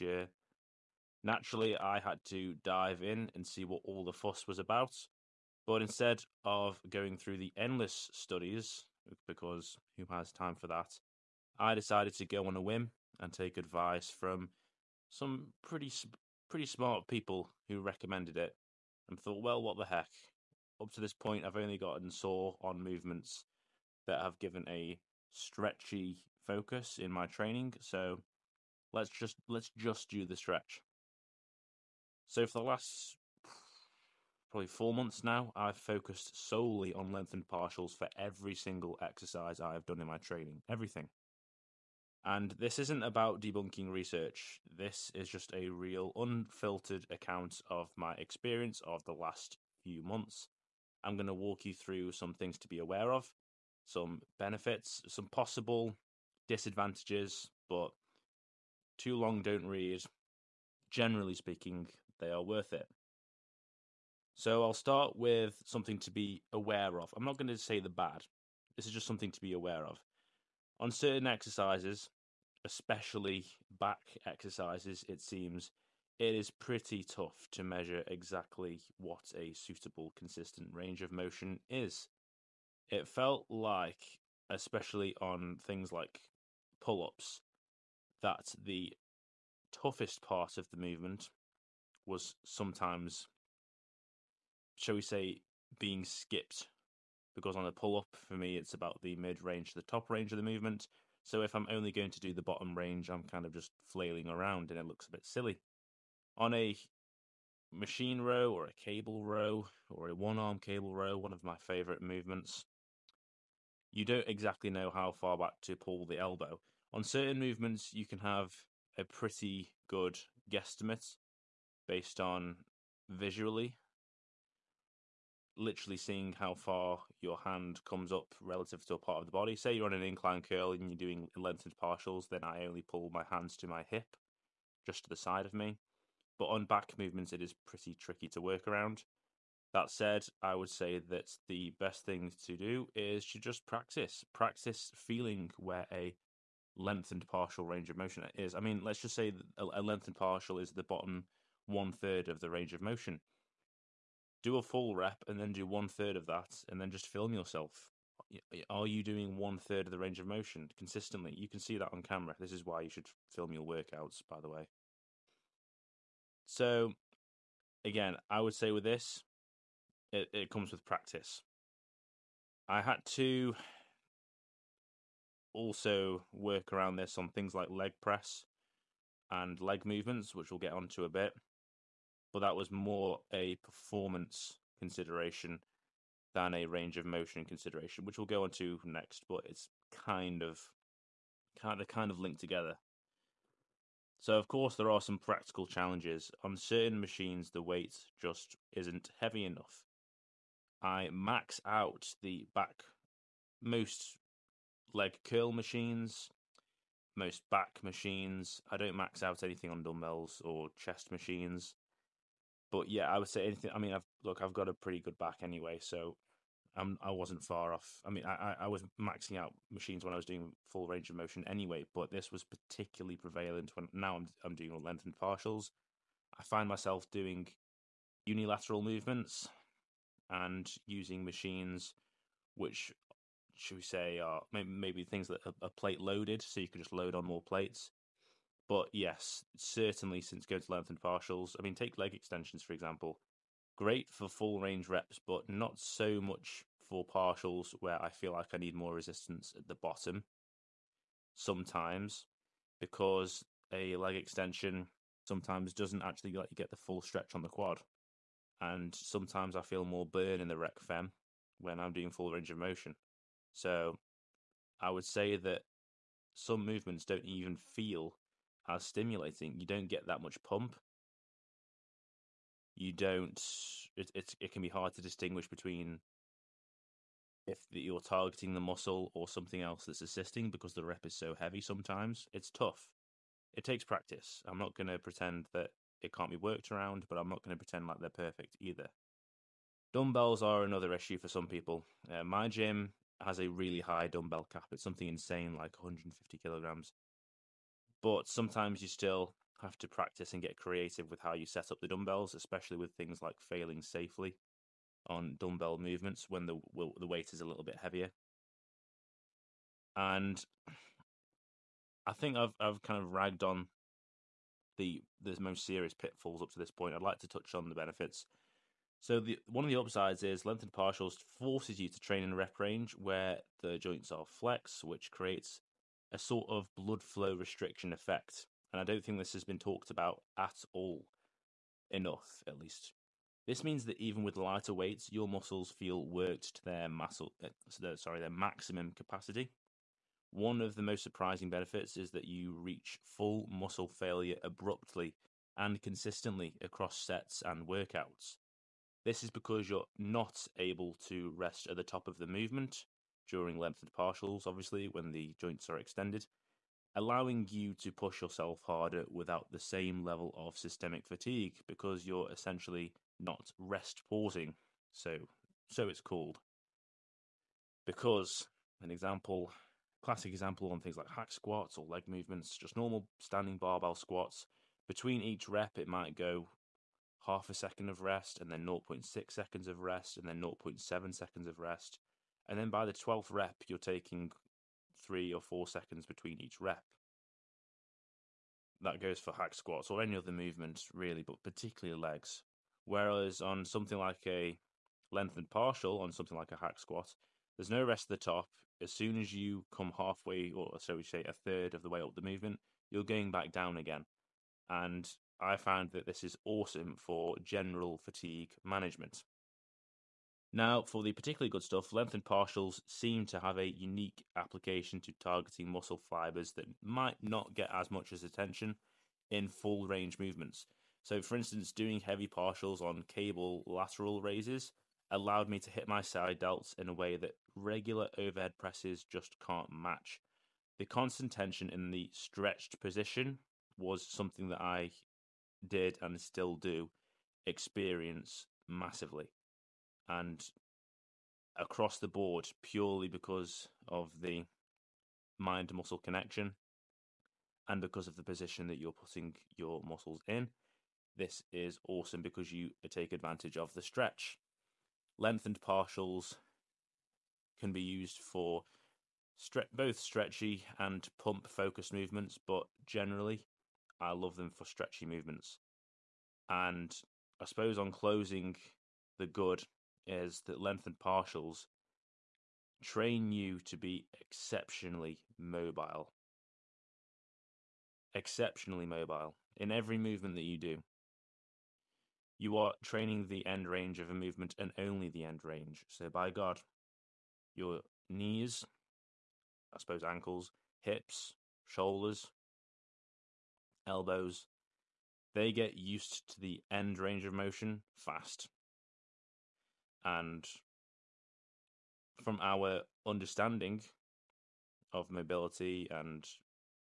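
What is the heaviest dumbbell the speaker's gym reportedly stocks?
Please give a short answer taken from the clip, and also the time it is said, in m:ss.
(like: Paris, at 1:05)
150 kilograms, at 4:55.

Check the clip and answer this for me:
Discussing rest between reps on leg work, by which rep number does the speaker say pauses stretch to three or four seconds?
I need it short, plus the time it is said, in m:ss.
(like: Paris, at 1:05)
12th rep, at 6:22.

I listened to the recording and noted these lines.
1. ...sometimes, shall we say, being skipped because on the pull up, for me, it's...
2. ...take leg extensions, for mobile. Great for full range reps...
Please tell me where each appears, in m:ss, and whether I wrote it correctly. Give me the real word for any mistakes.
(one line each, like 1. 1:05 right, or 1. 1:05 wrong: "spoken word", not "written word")
1. 1:32 right
2. 4:01 wrong: "example", not "mobile".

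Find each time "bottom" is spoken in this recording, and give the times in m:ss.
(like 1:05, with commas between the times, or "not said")
1:42, 2:30, 4:09.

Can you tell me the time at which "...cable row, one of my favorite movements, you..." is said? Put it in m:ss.
1:50.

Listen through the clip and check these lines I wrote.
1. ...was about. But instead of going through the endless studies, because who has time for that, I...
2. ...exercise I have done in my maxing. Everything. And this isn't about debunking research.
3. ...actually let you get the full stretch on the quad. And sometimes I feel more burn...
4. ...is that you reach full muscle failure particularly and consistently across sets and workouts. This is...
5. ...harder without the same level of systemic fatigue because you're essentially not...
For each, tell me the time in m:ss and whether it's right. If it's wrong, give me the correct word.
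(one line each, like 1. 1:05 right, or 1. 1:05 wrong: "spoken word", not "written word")
1. 0:04 right
2. 0:39 wrong: "training", not "maxing"
3. 4:16 right
4. 5:41 wrong: "abruptly", not "particularly"
5. 5:58 right.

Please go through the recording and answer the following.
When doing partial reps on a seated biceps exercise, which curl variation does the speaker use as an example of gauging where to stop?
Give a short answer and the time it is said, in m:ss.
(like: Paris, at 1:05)
Incline curl, at 2:10.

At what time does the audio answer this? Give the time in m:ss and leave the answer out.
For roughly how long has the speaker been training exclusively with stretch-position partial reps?
0:34.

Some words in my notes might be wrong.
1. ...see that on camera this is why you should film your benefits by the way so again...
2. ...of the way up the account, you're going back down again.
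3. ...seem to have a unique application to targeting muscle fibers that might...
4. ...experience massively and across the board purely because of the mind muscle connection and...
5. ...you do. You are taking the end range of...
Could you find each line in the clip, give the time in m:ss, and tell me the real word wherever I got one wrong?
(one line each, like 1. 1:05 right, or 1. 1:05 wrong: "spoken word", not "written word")
1. 2:41 wrong: "workouts", not "benefits"
2. 6:41 wrong: "movement", not "account"
3. 6:52 right
4. 7:17 right
5. 8:00 wrong: "training", not "taking".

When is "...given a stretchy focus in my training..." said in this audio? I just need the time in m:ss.
0:24.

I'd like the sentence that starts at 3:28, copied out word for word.
I don't max out anything on dumbbells or chest machines but yeah, I would say anything.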